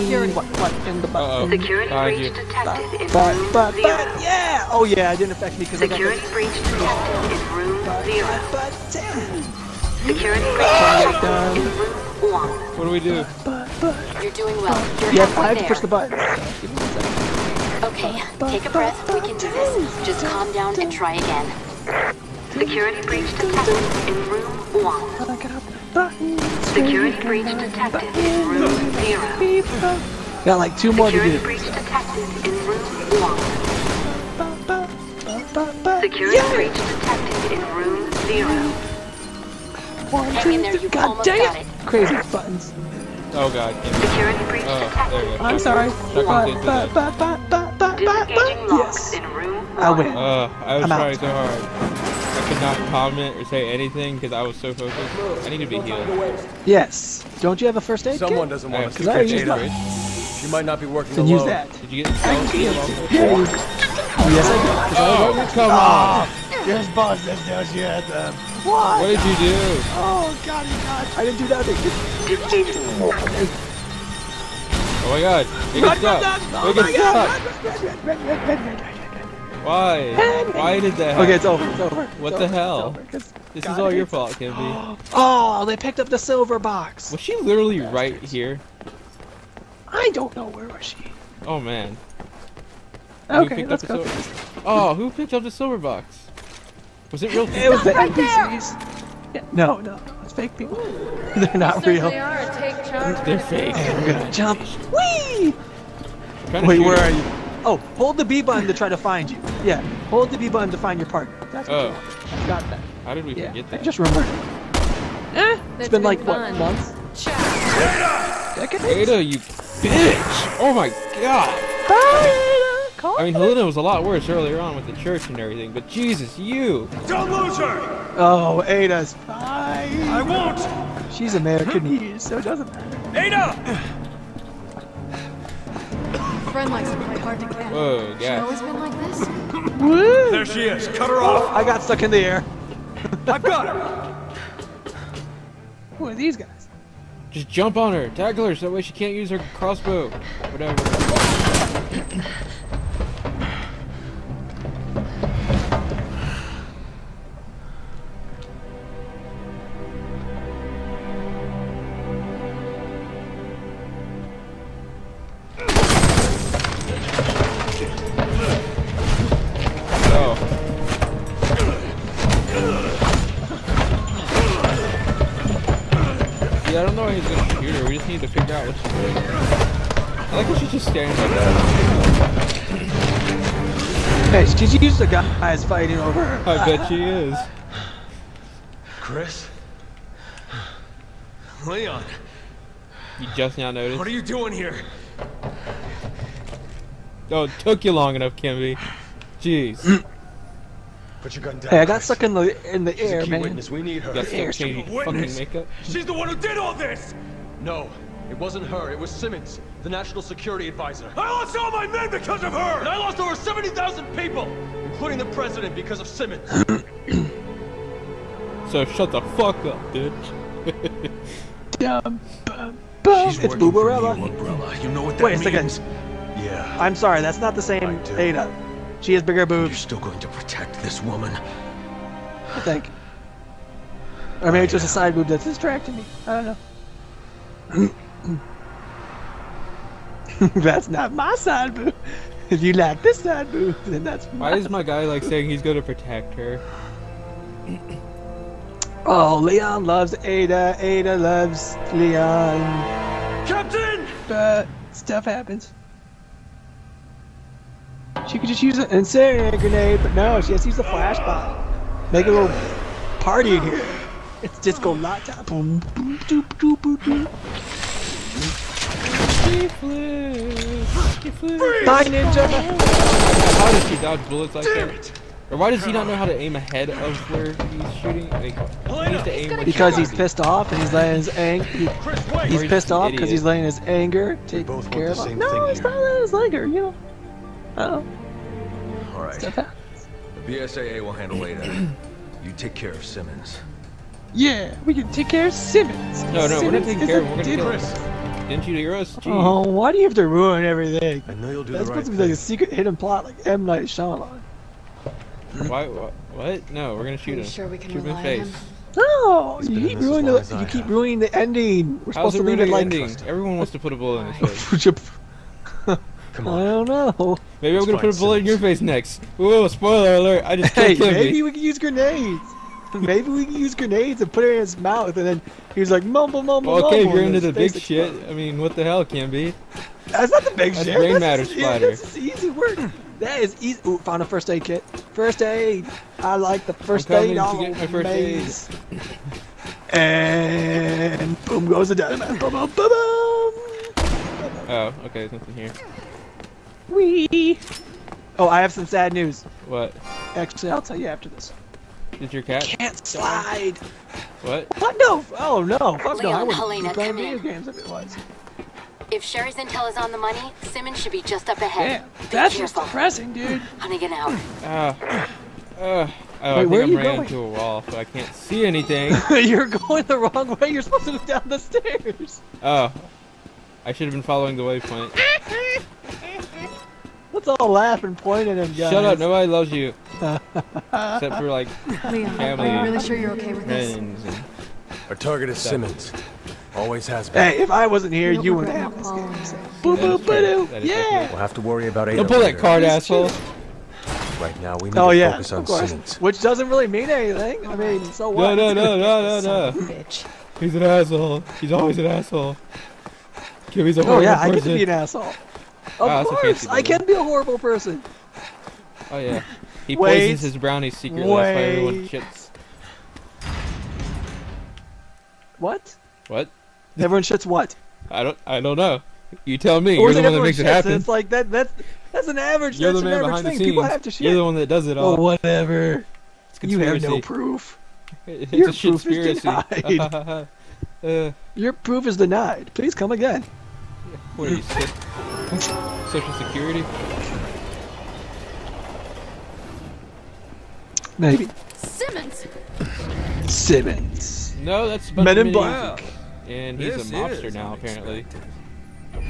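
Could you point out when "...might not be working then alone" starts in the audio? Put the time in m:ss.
1:00.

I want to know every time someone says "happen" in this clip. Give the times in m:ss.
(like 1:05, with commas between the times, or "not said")
1:21, 4:15, 7:00.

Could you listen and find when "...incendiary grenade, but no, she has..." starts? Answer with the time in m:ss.
4:18.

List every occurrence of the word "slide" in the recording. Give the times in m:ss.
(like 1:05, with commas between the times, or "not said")
5:53.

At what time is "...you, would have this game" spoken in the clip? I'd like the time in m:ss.
6:28.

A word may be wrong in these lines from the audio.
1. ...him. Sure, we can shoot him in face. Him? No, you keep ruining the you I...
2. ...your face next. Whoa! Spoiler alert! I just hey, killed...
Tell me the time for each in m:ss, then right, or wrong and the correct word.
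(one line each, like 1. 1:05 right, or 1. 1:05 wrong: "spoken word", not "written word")
1. 5:07 right
2. 5:18 right.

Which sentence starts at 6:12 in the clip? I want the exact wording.
Oh, I should have been following the waypoint.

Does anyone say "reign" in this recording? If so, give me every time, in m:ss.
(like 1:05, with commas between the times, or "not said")
not said.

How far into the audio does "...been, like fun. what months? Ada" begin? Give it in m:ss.
1:55.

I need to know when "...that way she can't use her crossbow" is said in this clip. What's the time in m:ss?
2:28.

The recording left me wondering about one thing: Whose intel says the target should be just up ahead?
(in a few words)
Sherry.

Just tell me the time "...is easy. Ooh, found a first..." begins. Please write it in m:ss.
5:33.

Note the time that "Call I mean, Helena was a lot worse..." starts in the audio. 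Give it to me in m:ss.
2:03.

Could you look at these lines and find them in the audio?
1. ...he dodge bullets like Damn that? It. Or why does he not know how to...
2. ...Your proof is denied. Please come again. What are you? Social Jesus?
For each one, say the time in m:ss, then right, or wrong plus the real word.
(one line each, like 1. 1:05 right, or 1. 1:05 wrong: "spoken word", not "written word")
1. 4:33 right
2. 7:11 wrong: "Security", not "Jesus".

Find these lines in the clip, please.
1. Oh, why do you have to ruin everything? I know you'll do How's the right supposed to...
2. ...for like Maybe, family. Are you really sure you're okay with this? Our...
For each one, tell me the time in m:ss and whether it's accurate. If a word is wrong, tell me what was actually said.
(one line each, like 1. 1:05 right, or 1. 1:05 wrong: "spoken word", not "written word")
1. 4:59 wrong: "That", not "How"
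2. 6:21 wrong: "Liam", not "Maybe".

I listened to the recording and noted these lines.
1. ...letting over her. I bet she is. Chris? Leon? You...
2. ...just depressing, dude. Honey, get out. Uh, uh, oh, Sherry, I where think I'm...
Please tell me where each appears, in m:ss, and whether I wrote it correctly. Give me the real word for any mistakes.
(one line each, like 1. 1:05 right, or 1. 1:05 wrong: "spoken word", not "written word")
1. 3:05 wrong: "fighting", not "letting"
2. 6:02 wrong: "Wait", not "Sherry".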